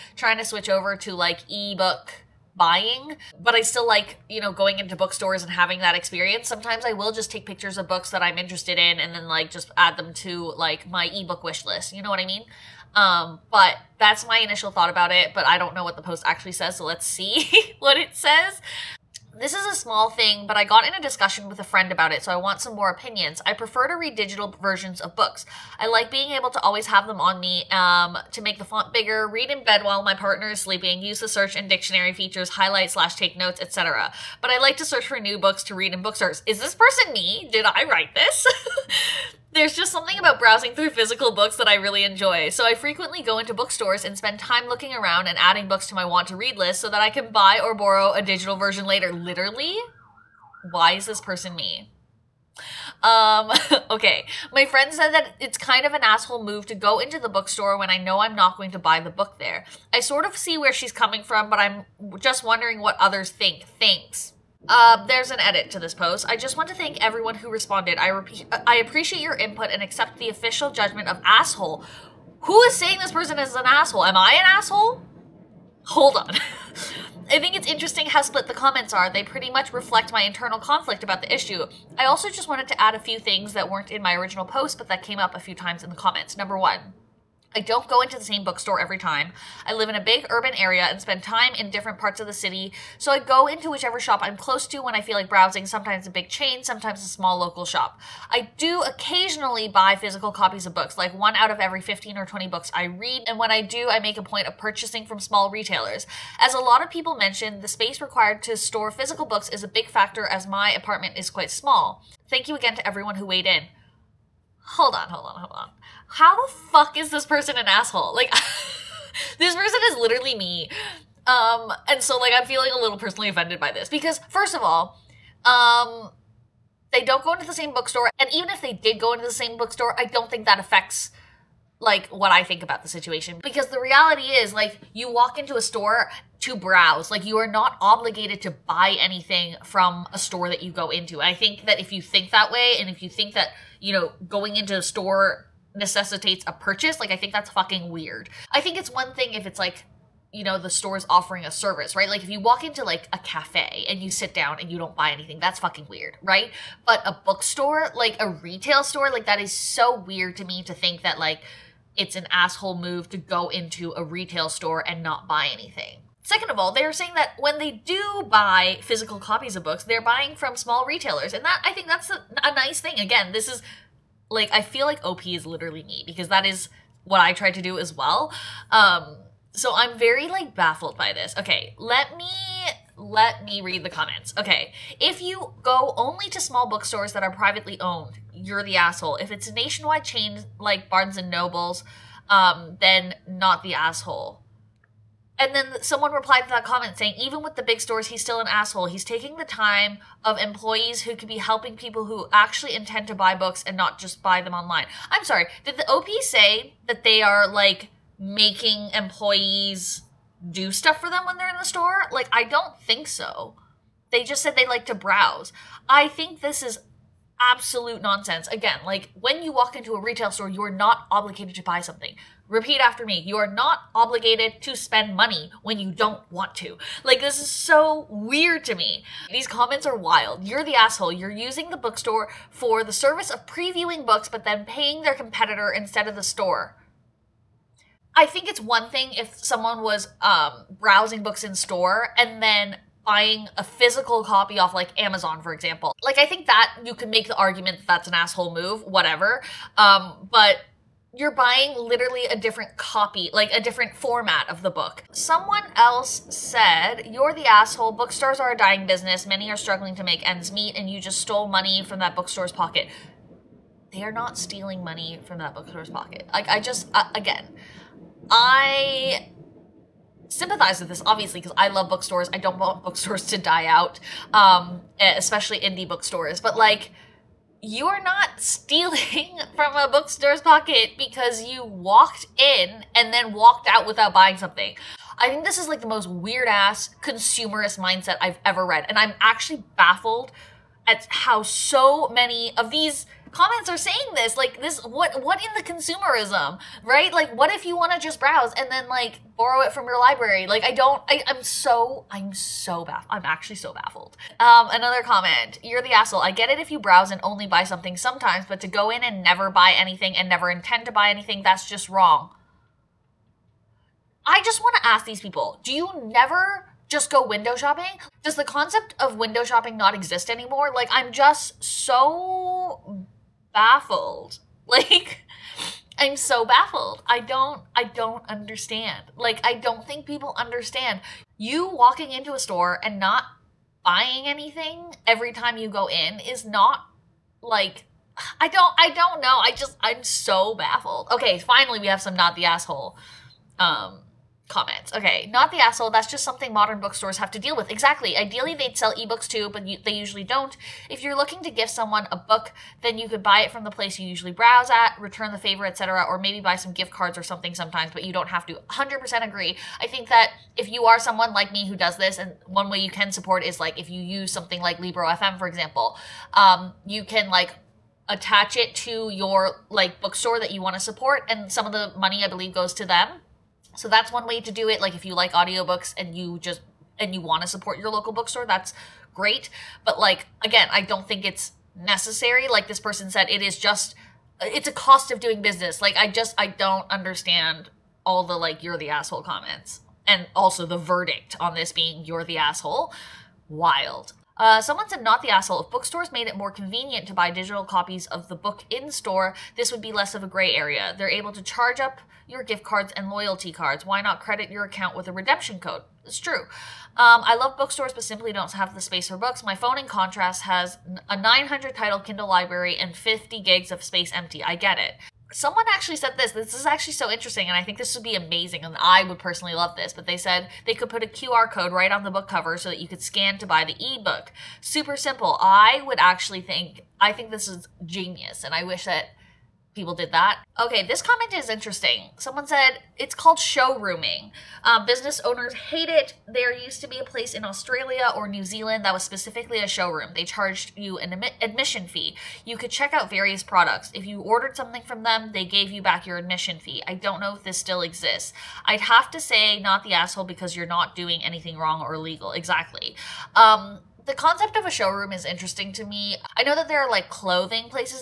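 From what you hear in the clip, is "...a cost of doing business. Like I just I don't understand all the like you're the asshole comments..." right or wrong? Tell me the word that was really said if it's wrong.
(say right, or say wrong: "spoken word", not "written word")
right.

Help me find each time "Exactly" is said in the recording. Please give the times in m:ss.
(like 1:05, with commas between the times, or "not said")
5:47, 7:32.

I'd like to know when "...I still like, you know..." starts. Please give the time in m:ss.
0:03.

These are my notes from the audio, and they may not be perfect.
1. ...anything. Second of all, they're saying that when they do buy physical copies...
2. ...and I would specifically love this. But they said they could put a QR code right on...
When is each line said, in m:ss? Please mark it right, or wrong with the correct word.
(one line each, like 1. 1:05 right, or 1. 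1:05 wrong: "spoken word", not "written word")
1. 2:45 right
2. 6:58 wrong: "personally", not "specifically".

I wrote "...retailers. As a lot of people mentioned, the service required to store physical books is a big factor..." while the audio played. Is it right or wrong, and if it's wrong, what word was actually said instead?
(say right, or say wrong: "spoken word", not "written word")
wrong: "space", not "service".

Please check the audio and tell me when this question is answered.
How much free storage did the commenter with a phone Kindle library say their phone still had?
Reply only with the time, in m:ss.
6:52.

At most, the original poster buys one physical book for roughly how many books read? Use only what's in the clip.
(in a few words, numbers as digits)
20.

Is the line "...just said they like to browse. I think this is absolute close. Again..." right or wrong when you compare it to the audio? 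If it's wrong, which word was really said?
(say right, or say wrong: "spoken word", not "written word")
wrong: "nonsense", not "close".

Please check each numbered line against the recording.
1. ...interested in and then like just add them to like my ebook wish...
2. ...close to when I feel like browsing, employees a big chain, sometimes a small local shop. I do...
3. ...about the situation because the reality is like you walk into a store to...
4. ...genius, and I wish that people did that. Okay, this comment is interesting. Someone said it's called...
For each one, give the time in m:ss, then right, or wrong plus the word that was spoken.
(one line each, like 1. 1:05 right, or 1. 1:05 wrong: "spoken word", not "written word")
1. 0:08 right
2. 1:34 wrong: "sometimes", not "employees"
3. 2:12 right
4. 7:07 right.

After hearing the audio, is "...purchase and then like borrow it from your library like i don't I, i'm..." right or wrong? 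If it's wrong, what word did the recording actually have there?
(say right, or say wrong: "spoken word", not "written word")
wrong: "browse", not "purchase".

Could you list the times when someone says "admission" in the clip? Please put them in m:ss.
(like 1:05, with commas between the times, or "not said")
7:21, 7:26.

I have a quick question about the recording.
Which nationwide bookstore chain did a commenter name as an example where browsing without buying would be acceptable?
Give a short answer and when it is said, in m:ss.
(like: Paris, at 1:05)
Barnes and Nobles, at 3:10.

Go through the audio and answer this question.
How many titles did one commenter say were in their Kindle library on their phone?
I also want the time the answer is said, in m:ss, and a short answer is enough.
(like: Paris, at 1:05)
900, at 6:51.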